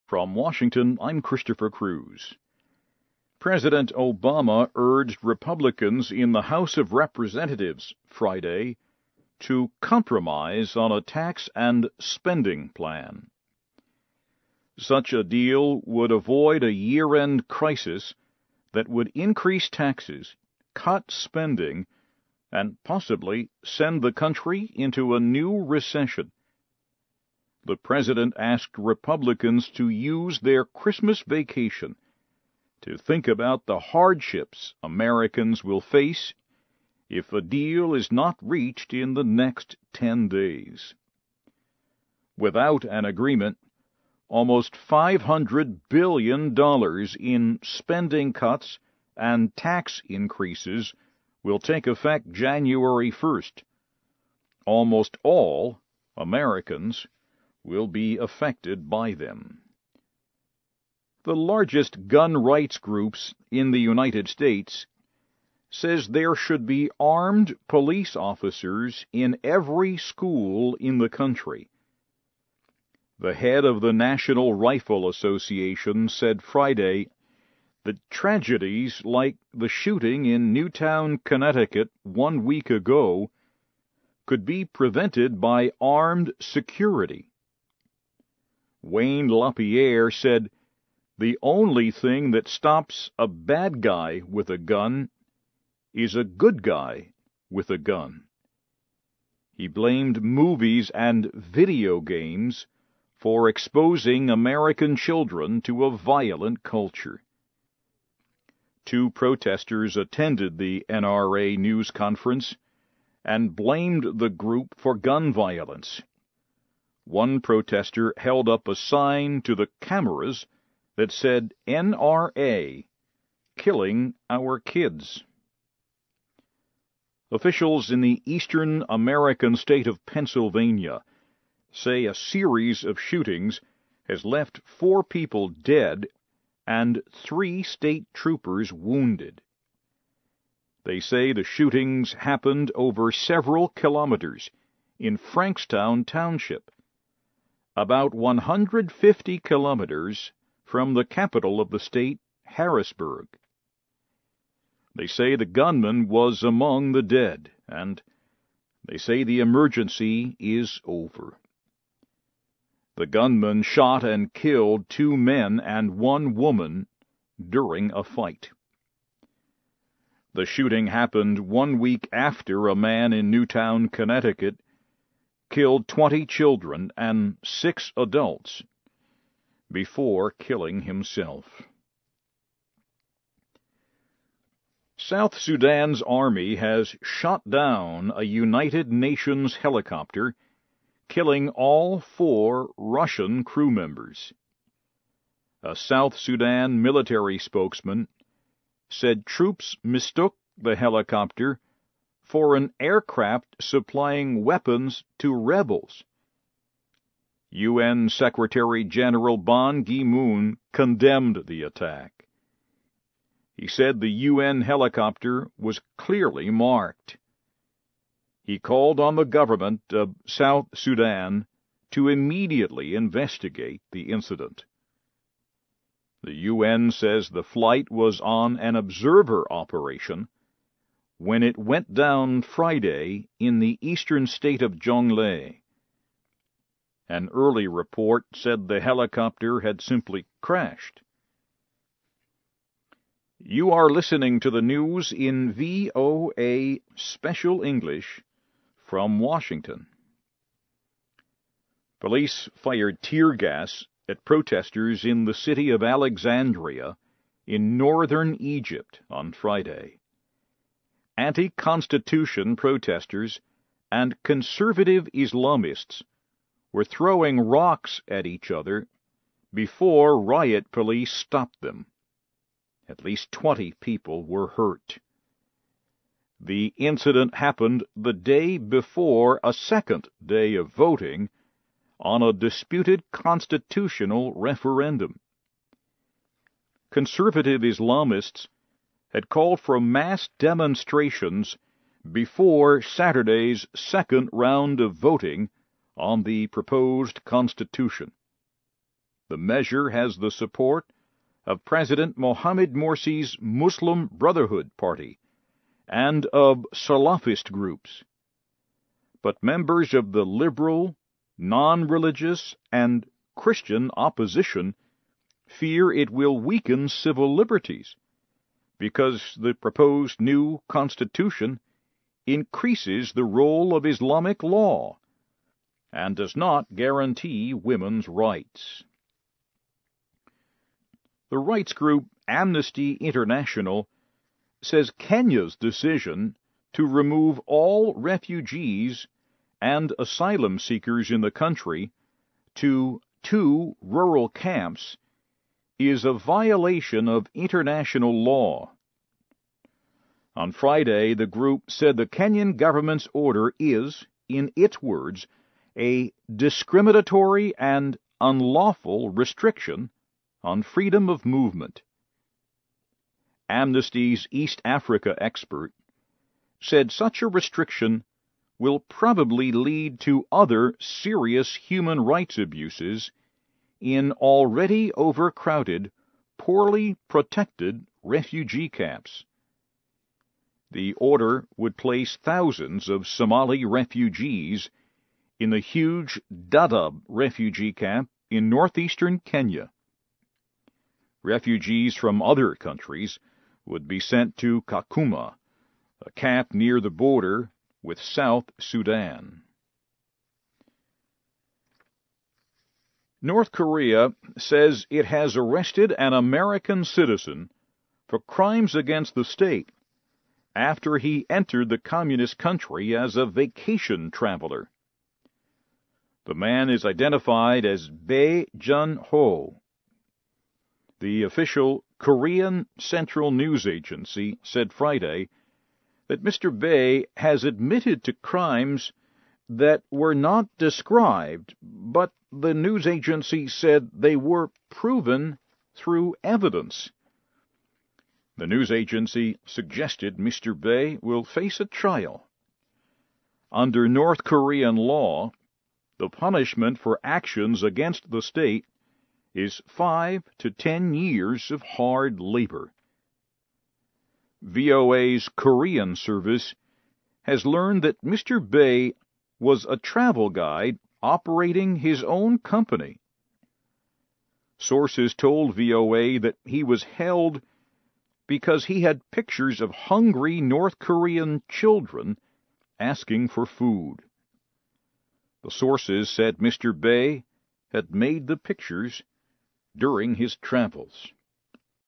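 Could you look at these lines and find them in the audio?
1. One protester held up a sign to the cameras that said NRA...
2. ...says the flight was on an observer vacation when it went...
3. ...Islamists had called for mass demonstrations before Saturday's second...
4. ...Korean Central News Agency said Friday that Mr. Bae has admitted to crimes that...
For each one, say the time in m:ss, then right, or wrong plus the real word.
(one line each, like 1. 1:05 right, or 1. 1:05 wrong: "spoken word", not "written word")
1. 1:57 right
2. 3:46 wrong: "operation", not "vacation"
3. 4:47 right
4. 7:01 right.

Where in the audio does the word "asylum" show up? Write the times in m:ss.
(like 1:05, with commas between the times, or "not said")
5:39.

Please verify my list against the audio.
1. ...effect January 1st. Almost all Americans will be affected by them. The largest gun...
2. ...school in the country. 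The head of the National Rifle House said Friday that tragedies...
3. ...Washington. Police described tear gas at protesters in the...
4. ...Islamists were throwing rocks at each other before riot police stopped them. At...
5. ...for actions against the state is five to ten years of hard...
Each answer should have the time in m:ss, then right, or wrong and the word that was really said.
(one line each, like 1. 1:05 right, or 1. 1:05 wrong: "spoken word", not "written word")
1. 0:51 right
2. 1:09 wrong: "Association", not "House"
3. 4:09 wrong: "fired", not "described"
4. 4:25 right
5. 7:26 right.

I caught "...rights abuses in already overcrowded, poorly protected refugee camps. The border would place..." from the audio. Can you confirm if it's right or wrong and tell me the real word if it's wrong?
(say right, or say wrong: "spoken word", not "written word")
wrong: "order", not "border".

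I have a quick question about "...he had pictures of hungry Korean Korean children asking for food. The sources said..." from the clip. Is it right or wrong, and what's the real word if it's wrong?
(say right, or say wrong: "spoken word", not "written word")
wrong: "North", not "Korean".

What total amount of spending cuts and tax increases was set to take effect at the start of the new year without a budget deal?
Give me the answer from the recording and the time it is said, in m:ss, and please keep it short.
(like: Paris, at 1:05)
almost $500 billion, at 0:44.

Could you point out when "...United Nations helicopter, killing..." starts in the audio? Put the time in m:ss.
3:08.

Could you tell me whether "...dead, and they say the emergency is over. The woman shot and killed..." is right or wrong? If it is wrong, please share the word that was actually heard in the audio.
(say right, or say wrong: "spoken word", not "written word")
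wrong: "gunman", not "woman".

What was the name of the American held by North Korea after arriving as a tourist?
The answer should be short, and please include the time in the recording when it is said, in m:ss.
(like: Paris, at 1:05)
Bae Jun Ho, at 6:57.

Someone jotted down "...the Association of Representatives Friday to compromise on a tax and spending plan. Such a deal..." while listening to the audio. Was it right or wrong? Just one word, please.
wrong.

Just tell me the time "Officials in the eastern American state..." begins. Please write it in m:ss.
2:07.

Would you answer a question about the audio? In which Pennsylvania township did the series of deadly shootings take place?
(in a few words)
Frankstown Township.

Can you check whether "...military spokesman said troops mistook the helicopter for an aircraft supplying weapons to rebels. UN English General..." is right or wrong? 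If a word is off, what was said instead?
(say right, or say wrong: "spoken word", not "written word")
wrong: "Secretary", not "English".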